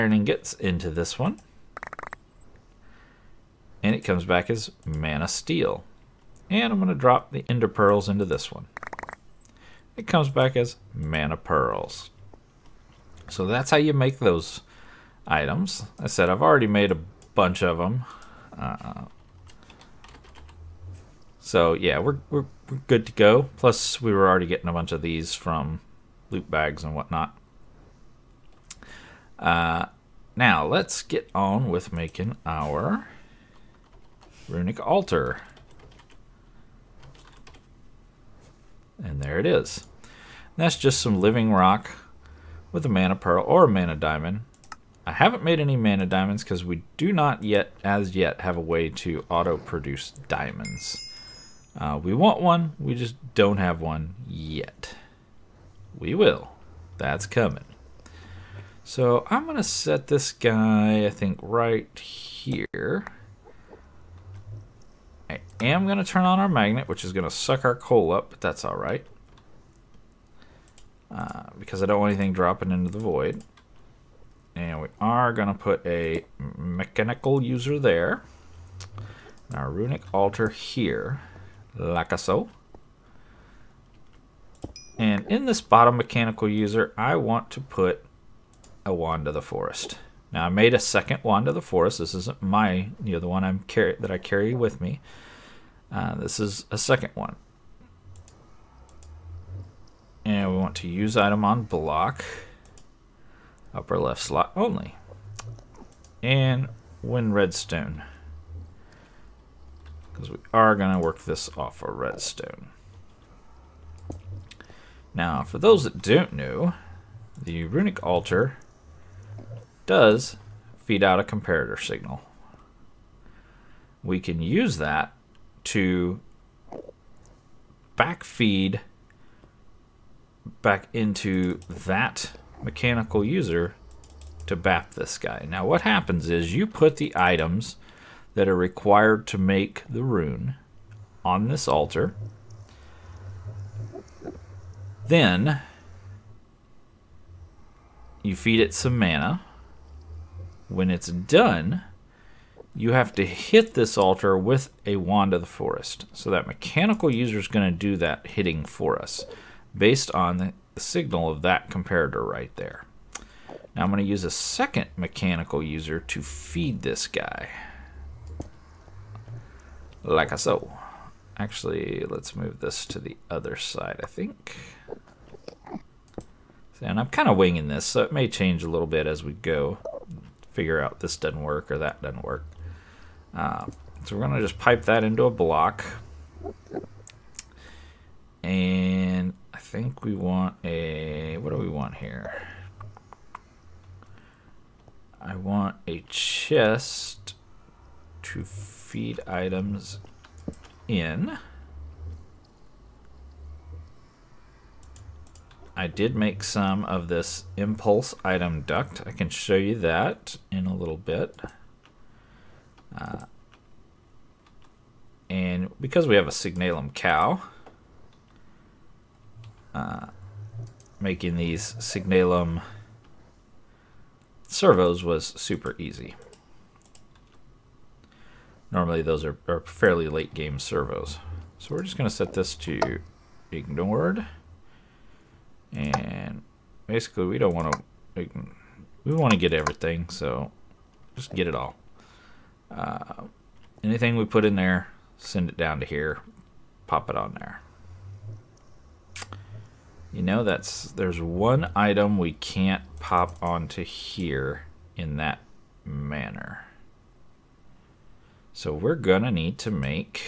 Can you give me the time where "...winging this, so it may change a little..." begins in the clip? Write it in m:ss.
2:57.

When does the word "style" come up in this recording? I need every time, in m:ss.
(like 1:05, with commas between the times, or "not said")
not said.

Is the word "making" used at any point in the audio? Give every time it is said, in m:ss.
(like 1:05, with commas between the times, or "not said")
0:31, 3:41.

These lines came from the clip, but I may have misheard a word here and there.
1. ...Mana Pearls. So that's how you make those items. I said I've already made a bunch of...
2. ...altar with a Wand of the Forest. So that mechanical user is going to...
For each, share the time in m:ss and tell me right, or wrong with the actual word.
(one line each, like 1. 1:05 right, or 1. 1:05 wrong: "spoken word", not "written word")
1. 0:10 right
2. 2:33 right.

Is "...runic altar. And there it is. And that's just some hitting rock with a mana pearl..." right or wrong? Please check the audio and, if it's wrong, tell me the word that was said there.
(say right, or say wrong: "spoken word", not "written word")
wrong: "living", not "hitting".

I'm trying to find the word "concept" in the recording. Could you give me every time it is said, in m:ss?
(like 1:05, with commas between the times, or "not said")
not said.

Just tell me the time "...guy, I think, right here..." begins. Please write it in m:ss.
1:00.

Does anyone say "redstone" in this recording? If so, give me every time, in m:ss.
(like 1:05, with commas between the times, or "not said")
1:47, 1:51.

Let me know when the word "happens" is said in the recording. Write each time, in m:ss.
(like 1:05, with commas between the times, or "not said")
2:15.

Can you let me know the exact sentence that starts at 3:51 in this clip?
So we're just going to set this to ignored.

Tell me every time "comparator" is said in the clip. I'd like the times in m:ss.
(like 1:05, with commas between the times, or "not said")
2:01, 2:41.